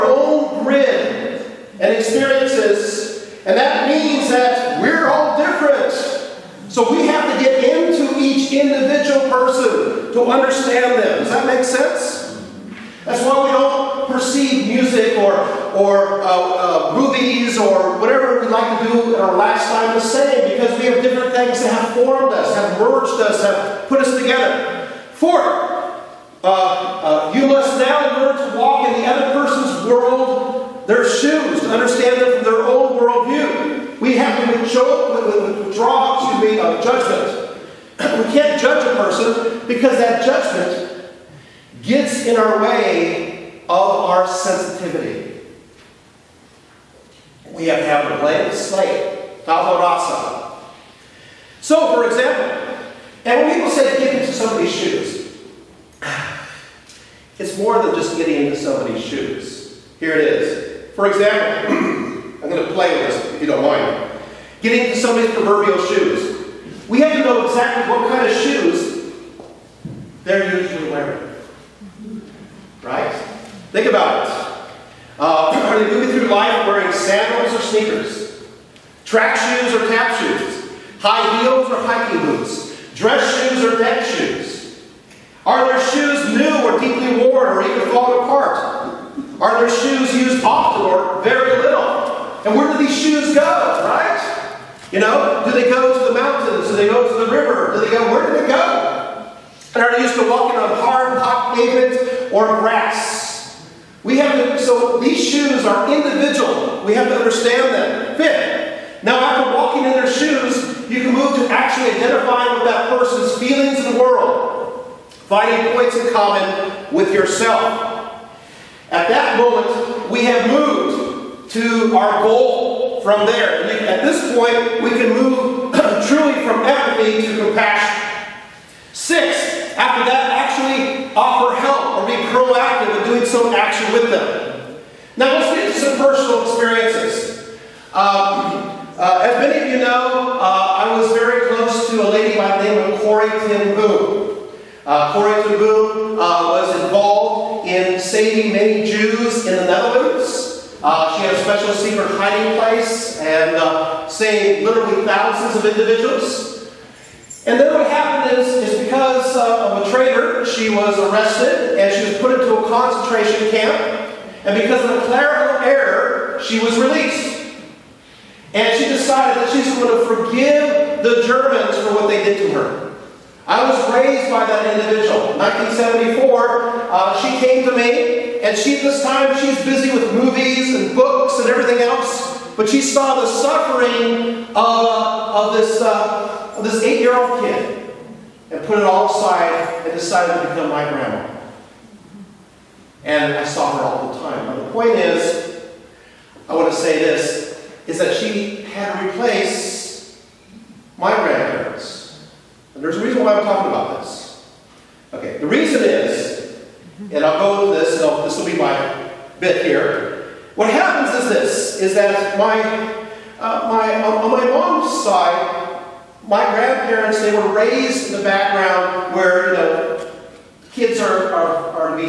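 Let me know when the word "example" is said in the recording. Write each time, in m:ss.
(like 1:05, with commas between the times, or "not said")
0:52, 1:01.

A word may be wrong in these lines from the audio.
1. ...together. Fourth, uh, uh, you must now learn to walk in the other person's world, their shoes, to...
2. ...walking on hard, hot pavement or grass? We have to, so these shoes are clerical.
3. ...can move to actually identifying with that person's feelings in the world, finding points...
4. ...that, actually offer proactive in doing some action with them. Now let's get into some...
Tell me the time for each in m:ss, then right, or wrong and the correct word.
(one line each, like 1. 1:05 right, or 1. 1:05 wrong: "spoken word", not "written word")
1. 0:24 right
2. 1:40 wrong: "individual", not "clerical"
3. 1:51 right
4. 2:10 right.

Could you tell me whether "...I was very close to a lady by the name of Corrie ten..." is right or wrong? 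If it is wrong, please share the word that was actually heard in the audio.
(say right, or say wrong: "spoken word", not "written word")
right.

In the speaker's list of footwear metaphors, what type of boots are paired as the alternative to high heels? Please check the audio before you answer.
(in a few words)
hiking boots.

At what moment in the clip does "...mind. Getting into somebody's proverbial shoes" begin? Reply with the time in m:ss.
1:03.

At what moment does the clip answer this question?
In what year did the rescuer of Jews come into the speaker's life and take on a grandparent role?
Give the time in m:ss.
2:55.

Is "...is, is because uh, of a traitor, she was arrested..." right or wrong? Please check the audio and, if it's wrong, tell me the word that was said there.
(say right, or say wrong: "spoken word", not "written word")
right.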